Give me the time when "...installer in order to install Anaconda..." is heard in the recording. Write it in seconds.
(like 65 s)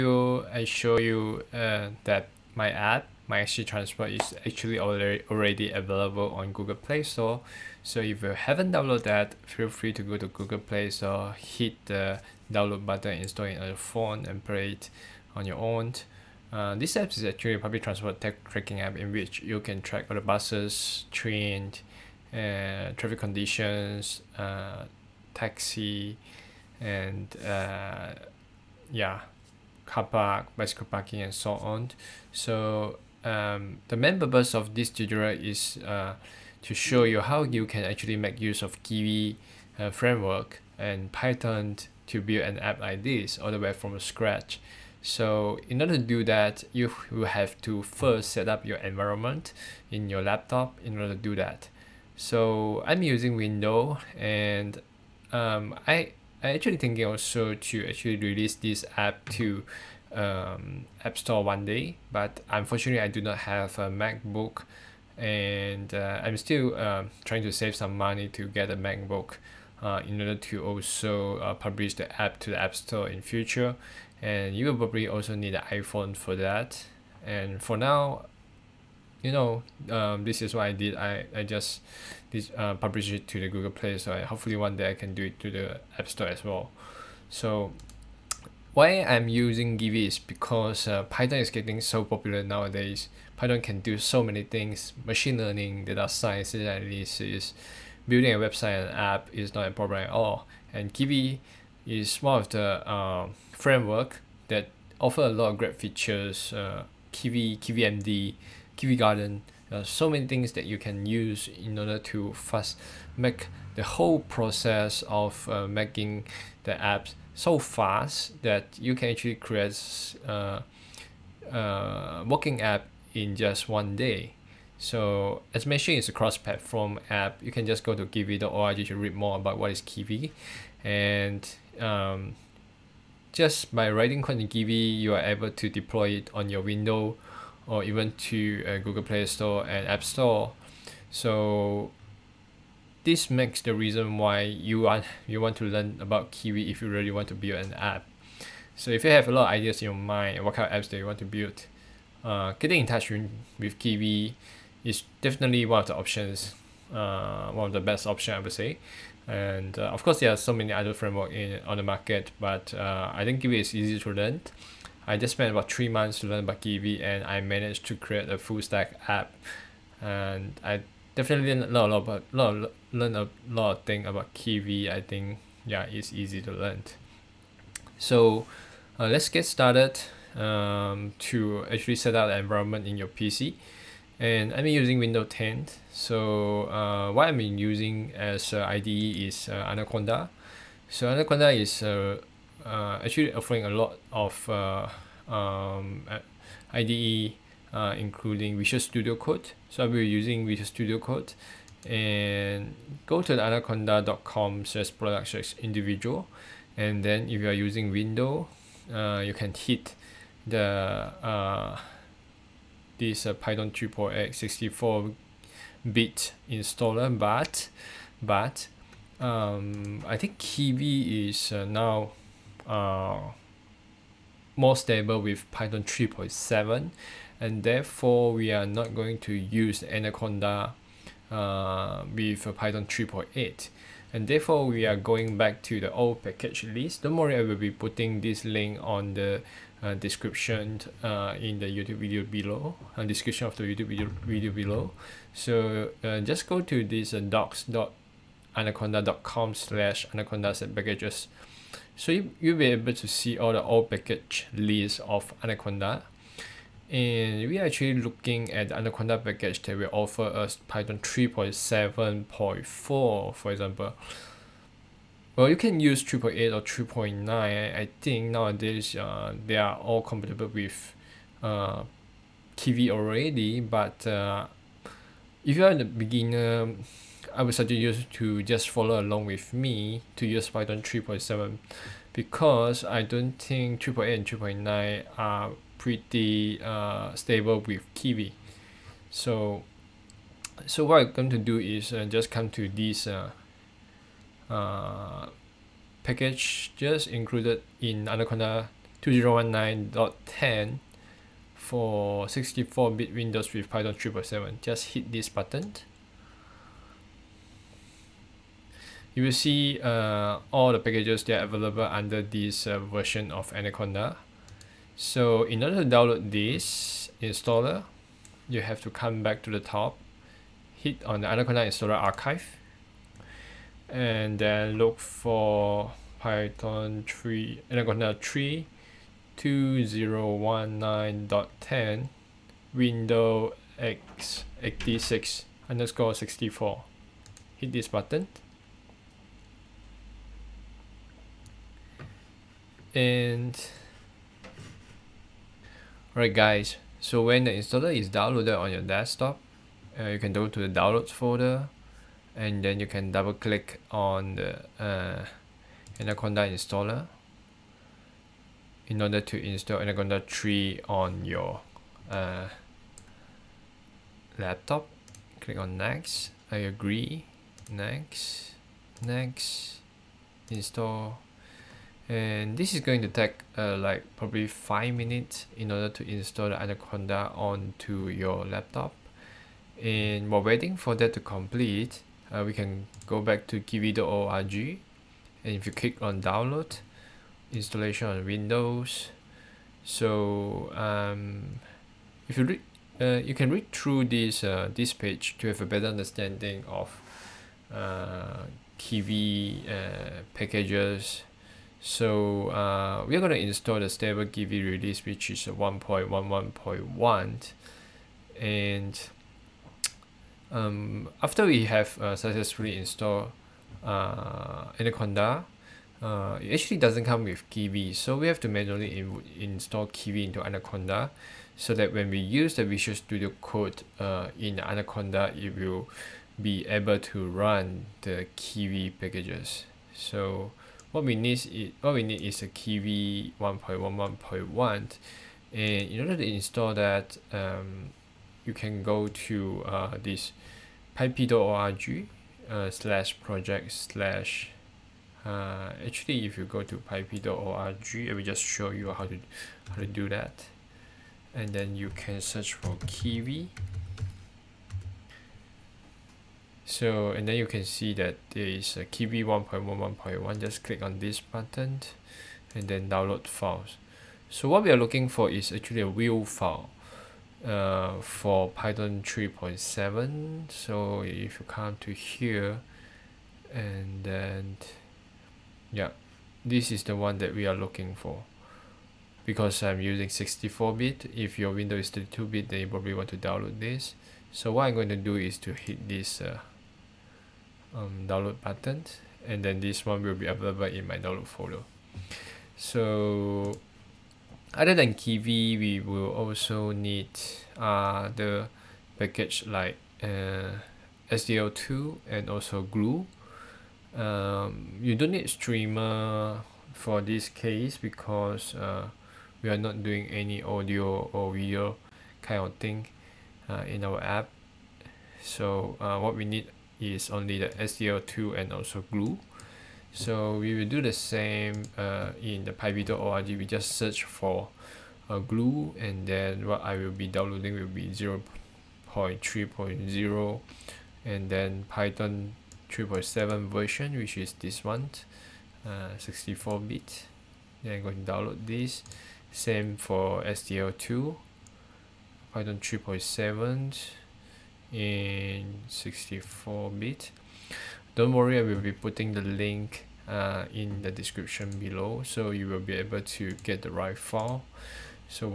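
356 s.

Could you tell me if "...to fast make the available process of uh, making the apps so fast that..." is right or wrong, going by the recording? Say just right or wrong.
wrong.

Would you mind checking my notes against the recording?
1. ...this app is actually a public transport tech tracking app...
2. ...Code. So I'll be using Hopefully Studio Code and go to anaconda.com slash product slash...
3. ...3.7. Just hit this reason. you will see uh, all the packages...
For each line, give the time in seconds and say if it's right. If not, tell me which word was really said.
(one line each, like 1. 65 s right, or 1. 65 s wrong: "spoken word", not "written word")
1. 16 s right
2. 199 s wrong: "Visual", not "Hopefully"
3. 303 s wrong: "button", not "reason".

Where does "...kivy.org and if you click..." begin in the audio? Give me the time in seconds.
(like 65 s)
383 s.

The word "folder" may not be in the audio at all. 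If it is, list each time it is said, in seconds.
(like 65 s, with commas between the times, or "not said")
351 s, 491 s.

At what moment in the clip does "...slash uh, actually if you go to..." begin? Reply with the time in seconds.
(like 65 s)
443 s.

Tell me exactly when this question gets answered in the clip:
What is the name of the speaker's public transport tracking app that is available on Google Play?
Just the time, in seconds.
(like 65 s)
3 s.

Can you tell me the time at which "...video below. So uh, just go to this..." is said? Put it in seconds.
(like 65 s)
244 s.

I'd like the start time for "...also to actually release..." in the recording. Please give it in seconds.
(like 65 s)
57 s.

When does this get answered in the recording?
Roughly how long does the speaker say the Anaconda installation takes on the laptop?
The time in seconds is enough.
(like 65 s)
374 s.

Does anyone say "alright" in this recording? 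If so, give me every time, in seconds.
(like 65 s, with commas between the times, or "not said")
346 s.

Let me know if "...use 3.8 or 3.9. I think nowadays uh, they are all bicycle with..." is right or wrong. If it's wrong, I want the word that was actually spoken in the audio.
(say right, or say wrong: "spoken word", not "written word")
wrong: "compatible", not "bicycle".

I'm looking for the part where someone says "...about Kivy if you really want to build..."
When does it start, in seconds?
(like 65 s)
146 s.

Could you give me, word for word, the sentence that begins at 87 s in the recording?
So why I'm using Kivy is because uh, Python is getting so popular nowadays.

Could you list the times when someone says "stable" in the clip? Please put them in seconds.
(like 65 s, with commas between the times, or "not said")
224 s, 287 s, 403 s.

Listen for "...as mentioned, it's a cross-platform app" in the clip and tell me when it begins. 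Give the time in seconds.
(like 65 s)
125 s.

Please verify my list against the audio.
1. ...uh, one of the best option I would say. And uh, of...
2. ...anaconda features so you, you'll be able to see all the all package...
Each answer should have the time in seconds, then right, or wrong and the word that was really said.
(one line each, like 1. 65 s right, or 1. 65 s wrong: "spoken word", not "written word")
1. 156 s right
2. 250 s wrong: "packages", not "features".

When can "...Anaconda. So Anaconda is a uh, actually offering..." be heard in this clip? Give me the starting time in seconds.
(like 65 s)
189 s.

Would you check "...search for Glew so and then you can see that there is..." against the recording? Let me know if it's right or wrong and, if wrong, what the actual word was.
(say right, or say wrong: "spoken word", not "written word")
wrong: "Kivy", not "Glew".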